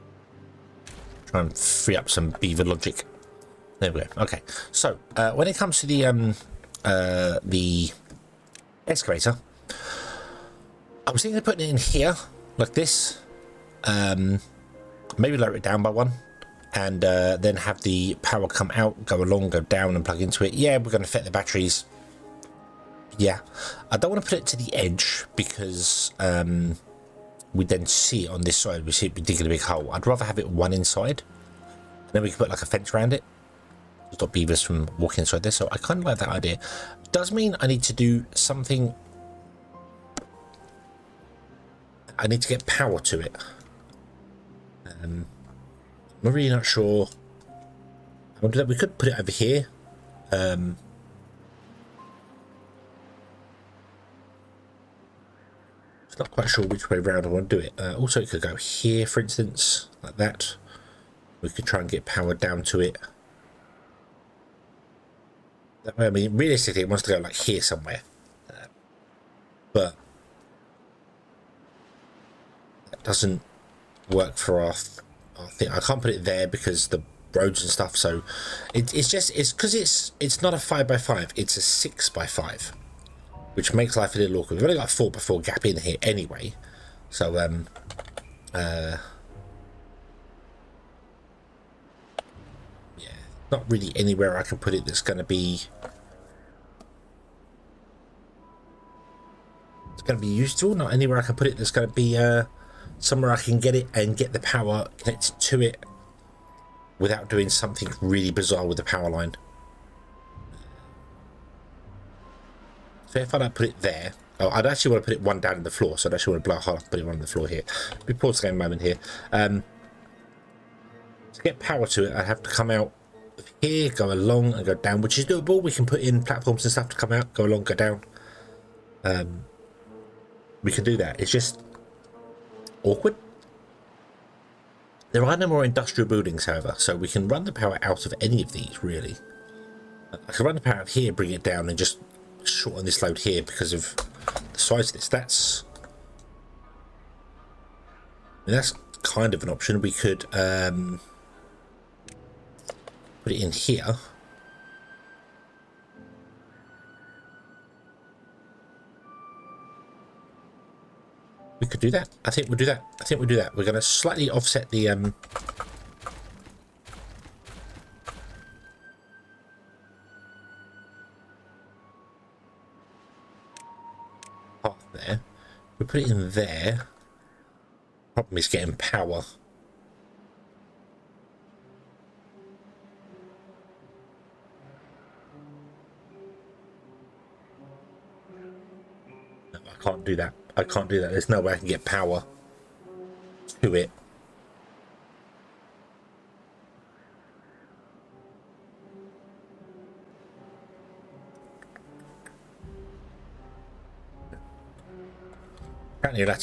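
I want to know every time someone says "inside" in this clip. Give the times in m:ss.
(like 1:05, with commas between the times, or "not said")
0:30, 0:35.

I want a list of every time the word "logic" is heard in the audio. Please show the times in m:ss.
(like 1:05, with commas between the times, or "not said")
0:02.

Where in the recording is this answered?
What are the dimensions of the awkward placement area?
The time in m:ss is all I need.
1:21.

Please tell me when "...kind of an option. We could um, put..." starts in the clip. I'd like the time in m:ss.
2:29.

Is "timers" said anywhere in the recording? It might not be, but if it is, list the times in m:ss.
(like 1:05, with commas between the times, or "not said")
not said.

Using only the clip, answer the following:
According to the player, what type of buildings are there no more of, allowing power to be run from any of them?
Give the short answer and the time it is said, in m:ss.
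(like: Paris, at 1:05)
Industrial buildings, at 2:15.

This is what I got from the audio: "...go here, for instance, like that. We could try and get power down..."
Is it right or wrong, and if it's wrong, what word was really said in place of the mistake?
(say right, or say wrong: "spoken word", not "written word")
right.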